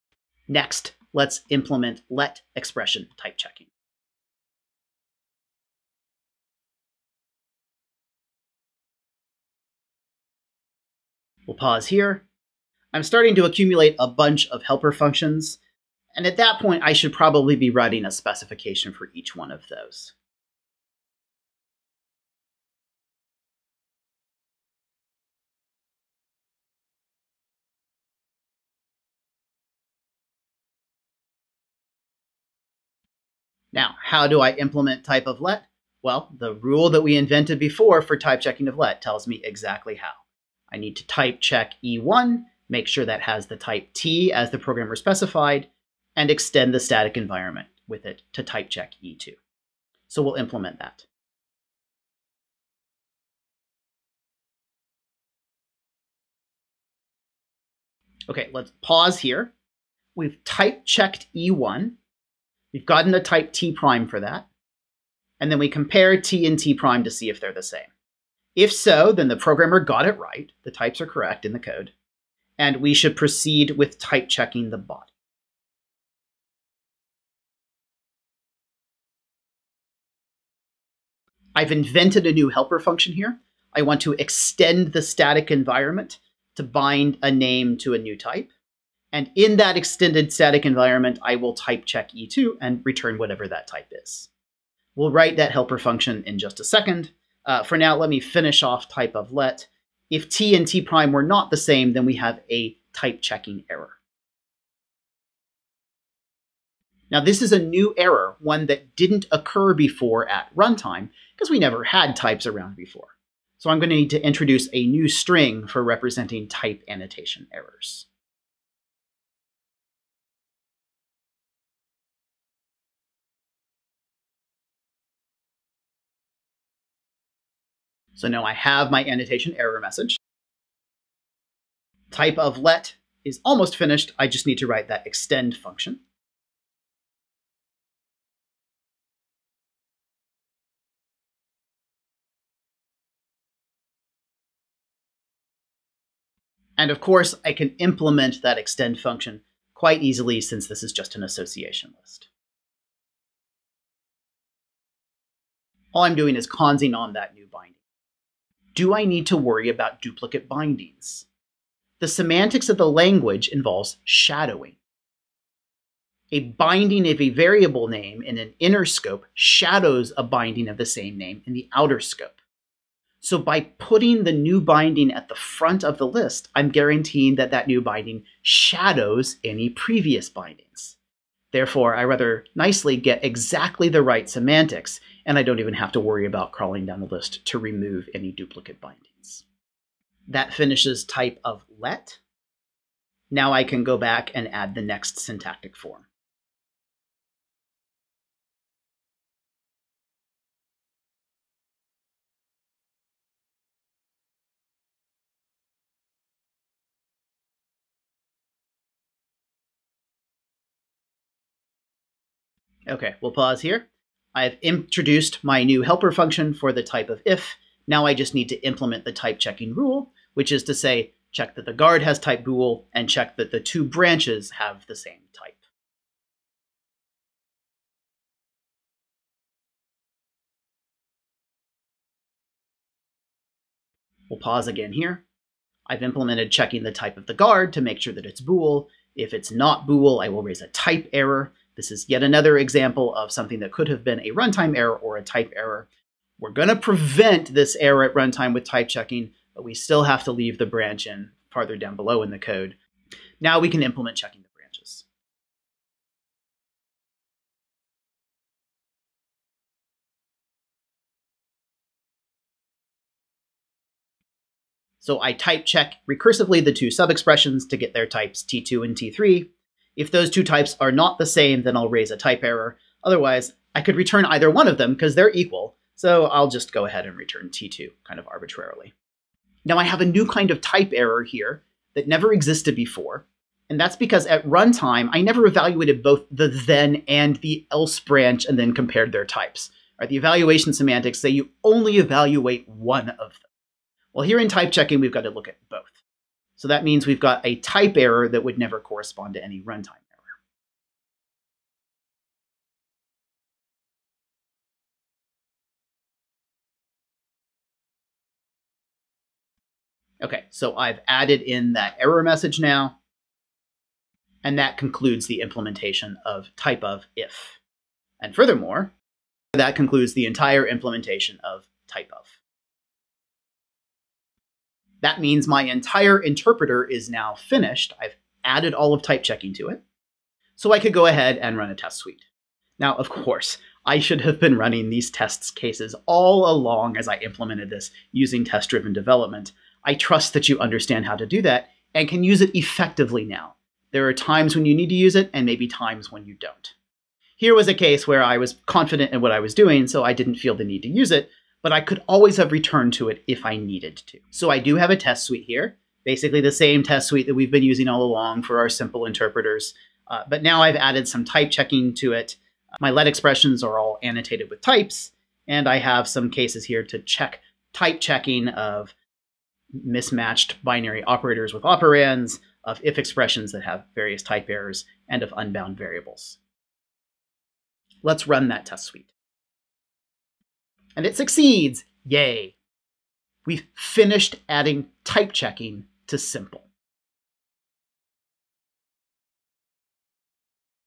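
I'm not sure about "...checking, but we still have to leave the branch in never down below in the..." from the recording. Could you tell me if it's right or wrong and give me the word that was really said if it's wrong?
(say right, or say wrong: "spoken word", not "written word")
wrong: "farther", not "never".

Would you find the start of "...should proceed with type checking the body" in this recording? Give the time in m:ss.
1:12.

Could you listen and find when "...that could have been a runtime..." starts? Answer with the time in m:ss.
4:03.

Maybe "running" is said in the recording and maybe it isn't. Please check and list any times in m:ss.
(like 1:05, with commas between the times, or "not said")
5:34.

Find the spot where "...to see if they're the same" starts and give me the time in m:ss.
1:07.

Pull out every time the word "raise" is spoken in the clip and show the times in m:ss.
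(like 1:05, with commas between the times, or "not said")
4:00, 4:31.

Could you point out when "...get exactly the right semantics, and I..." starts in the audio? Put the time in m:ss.
3:02.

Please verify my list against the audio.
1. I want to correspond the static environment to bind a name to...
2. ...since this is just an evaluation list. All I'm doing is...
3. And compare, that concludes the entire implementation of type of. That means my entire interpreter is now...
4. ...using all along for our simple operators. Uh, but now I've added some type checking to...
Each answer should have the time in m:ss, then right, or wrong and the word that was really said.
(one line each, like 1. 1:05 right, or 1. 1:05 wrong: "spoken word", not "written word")
1. 1:23 wrong: "extend", not "correspond"
2. 2:30 wrong: "association", not "evaluation"
3. 5:18 wrong: "furthermore", not "compare"
4. 5:57 wrong: "interpreters", not "operators".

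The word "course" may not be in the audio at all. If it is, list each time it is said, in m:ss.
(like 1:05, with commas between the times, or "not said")
2:27, 5:33.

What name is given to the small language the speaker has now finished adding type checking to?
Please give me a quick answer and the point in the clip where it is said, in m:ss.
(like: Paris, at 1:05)
SimPL, at 6:26.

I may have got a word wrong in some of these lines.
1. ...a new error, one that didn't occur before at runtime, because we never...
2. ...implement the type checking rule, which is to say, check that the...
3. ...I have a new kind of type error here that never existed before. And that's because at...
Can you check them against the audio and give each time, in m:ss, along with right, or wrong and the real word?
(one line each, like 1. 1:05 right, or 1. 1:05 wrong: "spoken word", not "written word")
1. 1:47 right
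2. 3:38 right
3. 4:39 right.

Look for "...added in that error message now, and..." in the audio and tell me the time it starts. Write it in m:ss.
5:11.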